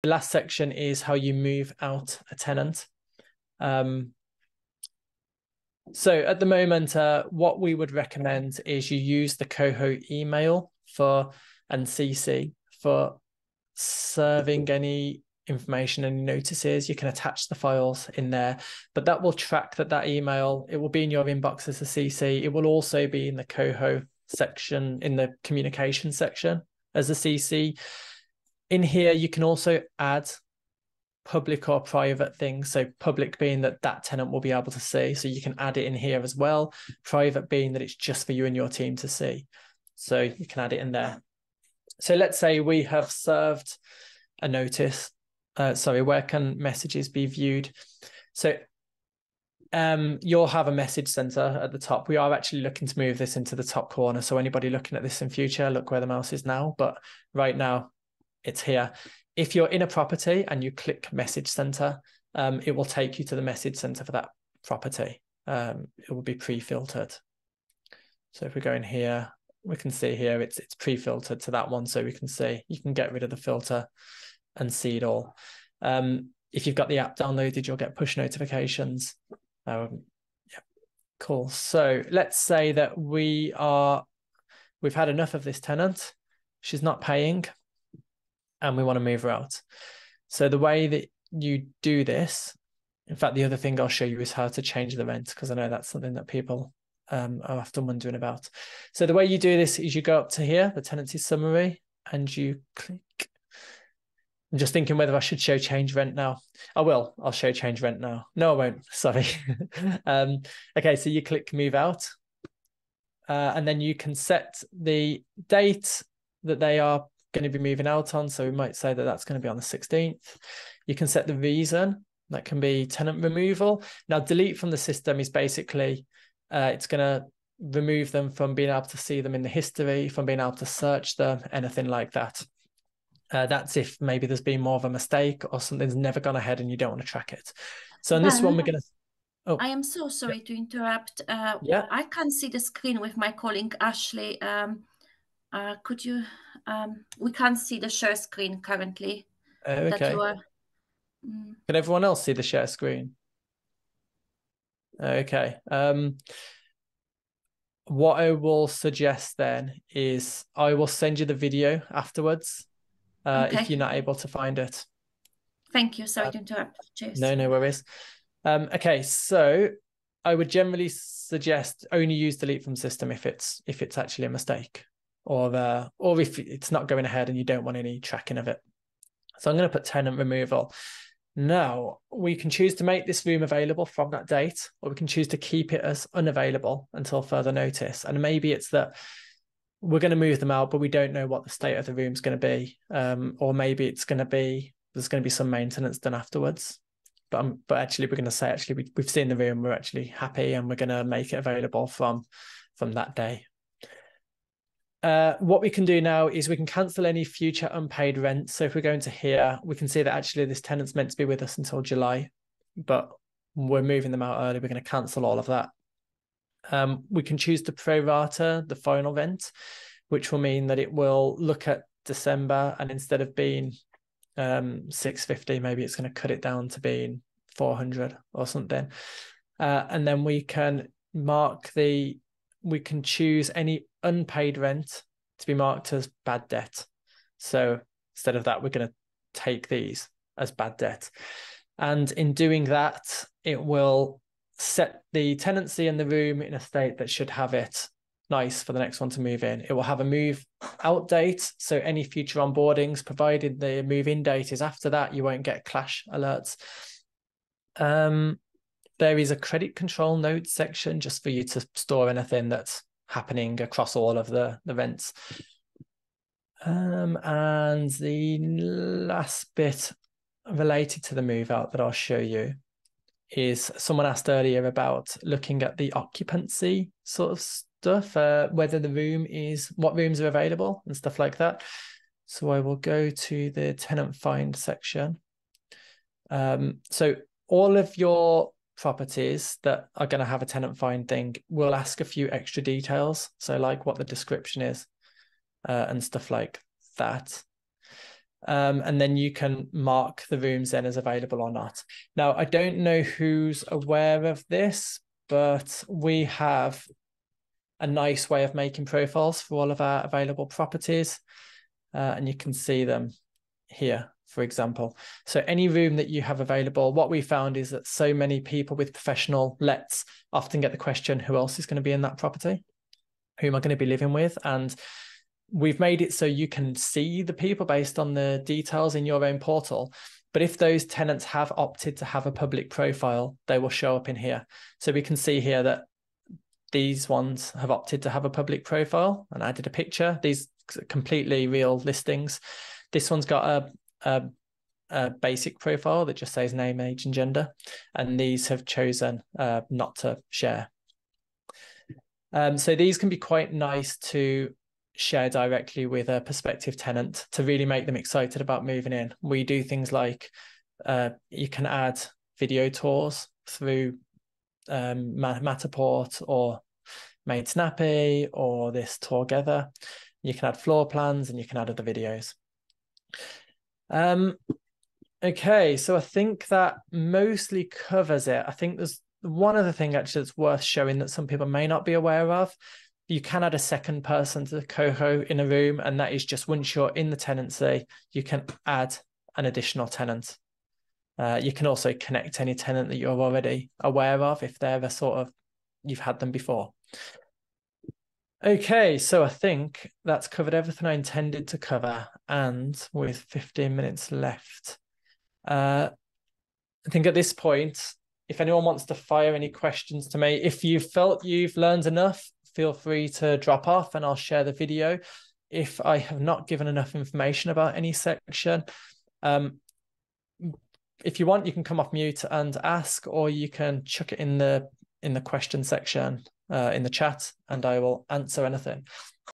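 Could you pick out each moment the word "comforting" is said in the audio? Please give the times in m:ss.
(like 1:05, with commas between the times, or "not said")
not said.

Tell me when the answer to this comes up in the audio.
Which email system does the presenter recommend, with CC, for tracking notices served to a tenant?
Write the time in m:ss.
0:09.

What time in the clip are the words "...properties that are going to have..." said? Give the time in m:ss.
4:48.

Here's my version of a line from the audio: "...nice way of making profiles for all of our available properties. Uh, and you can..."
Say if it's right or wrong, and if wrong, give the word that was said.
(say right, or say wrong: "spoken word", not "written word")
right.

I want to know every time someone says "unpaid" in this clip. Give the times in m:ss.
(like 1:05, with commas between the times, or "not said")
3:27, 3:54.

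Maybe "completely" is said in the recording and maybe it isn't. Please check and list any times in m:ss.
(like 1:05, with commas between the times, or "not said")
5:40.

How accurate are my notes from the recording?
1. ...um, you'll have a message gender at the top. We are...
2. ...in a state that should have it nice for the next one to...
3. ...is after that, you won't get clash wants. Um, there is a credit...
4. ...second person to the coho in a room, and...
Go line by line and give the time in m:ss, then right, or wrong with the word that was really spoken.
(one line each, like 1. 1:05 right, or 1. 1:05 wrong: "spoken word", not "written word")
1. 0:49 wrong: "center", not "gender"
2. 4:06 right
3. 4:14 wrong: "alerts", not "wants"
4. 6:23 right.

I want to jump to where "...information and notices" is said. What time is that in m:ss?
0:15.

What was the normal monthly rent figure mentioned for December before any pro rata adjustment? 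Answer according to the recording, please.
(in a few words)
650.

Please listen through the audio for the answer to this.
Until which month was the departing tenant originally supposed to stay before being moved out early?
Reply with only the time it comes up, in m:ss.
3:31.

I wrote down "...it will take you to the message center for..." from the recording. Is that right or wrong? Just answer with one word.
right.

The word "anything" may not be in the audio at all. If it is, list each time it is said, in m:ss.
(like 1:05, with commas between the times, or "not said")
2:11, 4:22, 7:08.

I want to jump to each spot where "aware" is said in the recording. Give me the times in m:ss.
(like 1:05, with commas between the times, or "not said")
5:03, 6:21, 6:33.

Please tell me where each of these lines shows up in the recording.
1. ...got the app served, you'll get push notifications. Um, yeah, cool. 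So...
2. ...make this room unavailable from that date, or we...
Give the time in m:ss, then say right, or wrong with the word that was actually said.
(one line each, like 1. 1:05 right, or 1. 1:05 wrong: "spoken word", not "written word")
1. 1:16 wrong: "downloaded", not "served"
2. 3:02 wrong: "available", not "unavailable".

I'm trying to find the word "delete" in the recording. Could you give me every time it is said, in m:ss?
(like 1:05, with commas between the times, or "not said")
2:04, 2:52.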